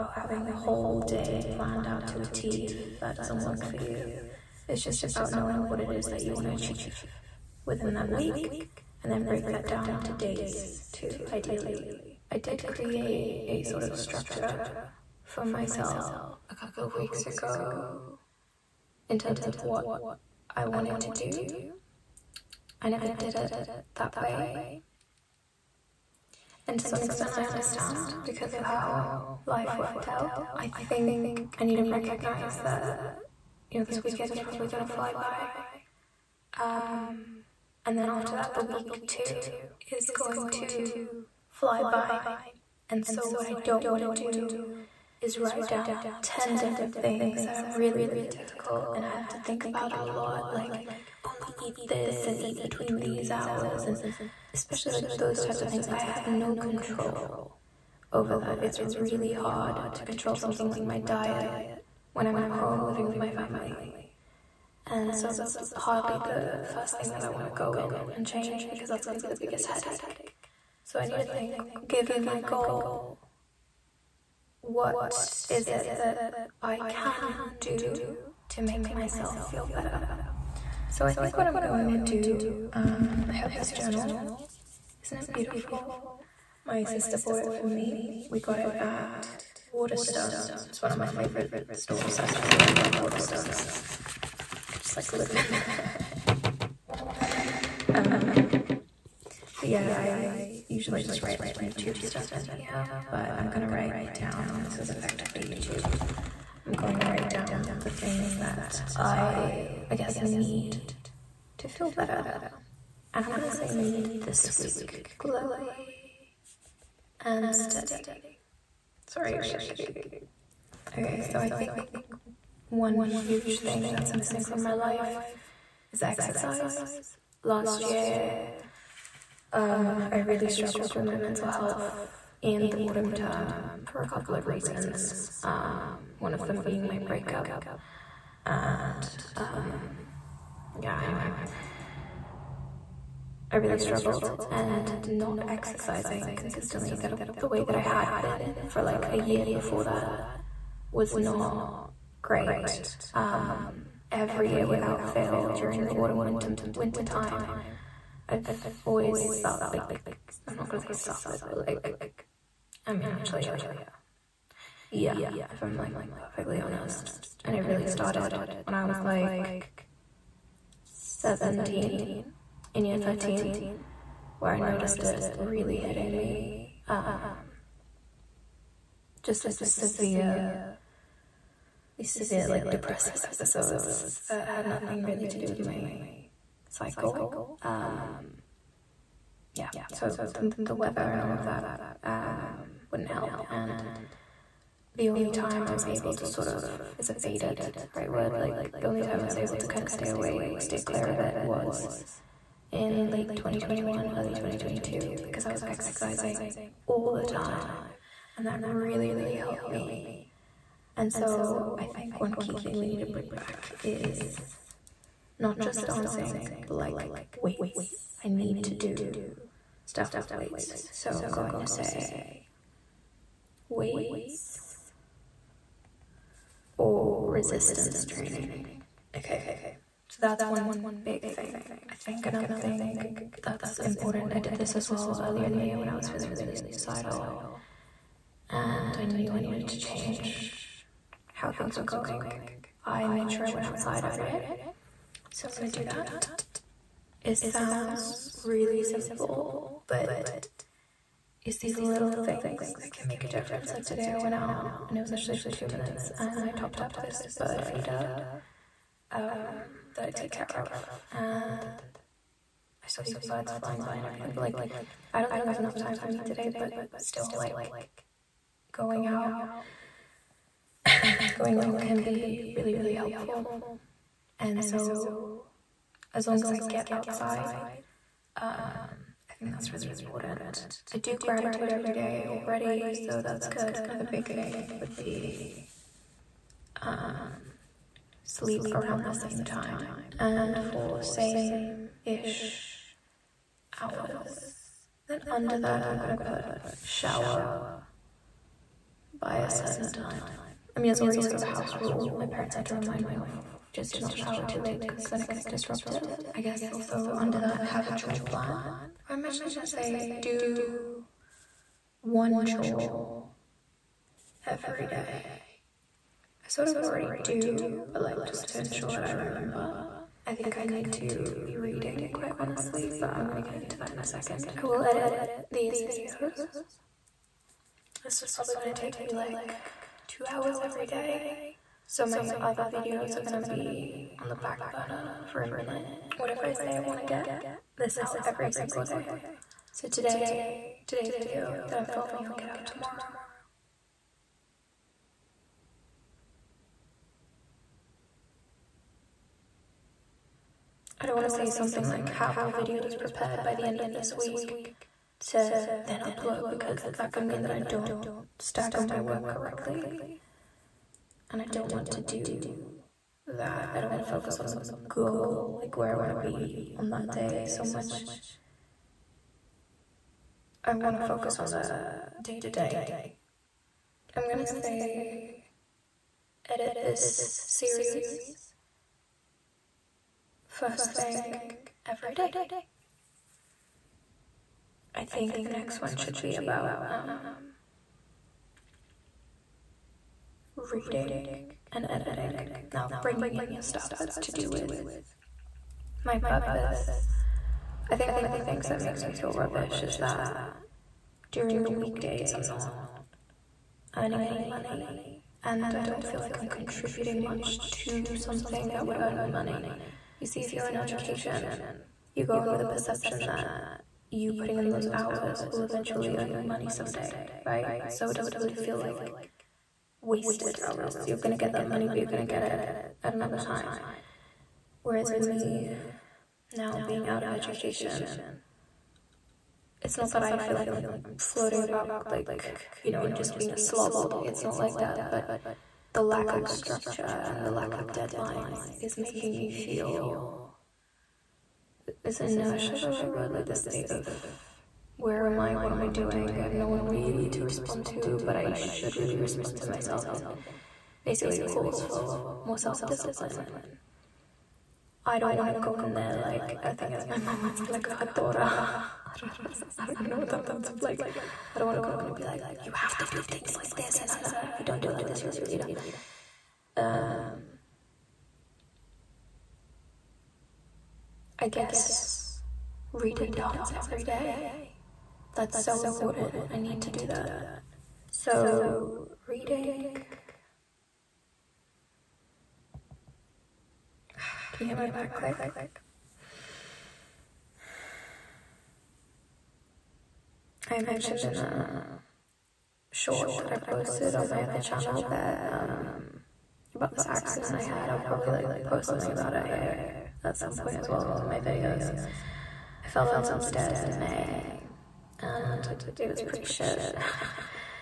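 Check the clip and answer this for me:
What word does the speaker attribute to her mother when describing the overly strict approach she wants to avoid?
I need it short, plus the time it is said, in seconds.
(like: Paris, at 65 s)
Hatora, at 457 s.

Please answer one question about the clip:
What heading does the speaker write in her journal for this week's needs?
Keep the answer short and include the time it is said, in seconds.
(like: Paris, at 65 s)
Glowy and steady, at 115 s.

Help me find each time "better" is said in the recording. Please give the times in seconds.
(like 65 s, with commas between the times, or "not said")
79 s, 111 s.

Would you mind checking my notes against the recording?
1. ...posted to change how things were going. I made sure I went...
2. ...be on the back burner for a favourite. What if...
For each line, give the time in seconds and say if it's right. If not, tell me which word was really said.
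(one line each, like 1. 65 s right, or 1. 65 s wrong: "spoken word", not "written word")
1. 239 s wrong: "needed", not "posted"
2. 333 s wrong: "minute", not "favourite".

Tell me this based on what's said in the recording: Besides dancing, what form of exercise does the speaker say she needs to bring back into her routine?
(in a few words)
Weights or resistance training.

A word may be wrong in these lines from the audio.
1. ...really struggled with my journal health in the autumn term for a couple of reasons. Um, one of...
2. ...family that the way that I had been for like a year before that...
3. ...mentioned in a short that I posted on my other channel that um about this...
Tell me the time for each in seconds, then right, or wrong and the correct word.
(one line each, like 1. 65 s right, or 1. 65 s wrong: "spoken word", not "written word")
1. 130 s wrong: "mental", not "journal"
2. 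146 s wrong: "consistently", not "family"
3. 490 s right.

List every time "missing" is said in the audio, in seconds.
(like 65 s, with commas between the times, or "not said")
124 s.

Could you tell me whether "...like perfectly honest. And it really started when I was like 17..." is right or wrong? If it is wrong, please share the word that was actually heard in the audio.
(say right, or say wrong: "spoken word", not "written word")
right.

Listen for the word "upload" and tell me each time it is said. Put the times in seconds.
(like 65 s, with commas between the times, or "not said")
355 s.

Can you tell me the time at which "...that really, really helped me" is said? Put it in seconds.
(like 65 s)
208 s.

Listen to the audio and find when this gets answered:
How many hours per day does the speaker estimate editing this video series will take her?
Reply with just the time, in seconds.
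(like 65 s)
330 s.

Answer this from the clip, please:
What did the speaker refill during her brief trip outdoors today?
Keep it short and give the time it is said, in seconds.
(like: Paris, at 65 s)
Bird feeder, at 257 s.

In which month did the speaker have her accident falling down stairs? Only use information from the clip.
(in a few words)
May.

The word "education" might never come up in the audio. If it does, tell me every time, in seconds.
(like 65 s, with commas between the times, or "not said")
410 s, 427 s.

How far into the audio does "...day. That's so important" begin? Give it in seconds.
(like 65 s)
474 s.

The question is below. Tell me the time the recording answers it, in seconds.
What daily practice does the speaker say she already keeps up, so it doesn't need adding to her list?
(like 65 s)
281 s.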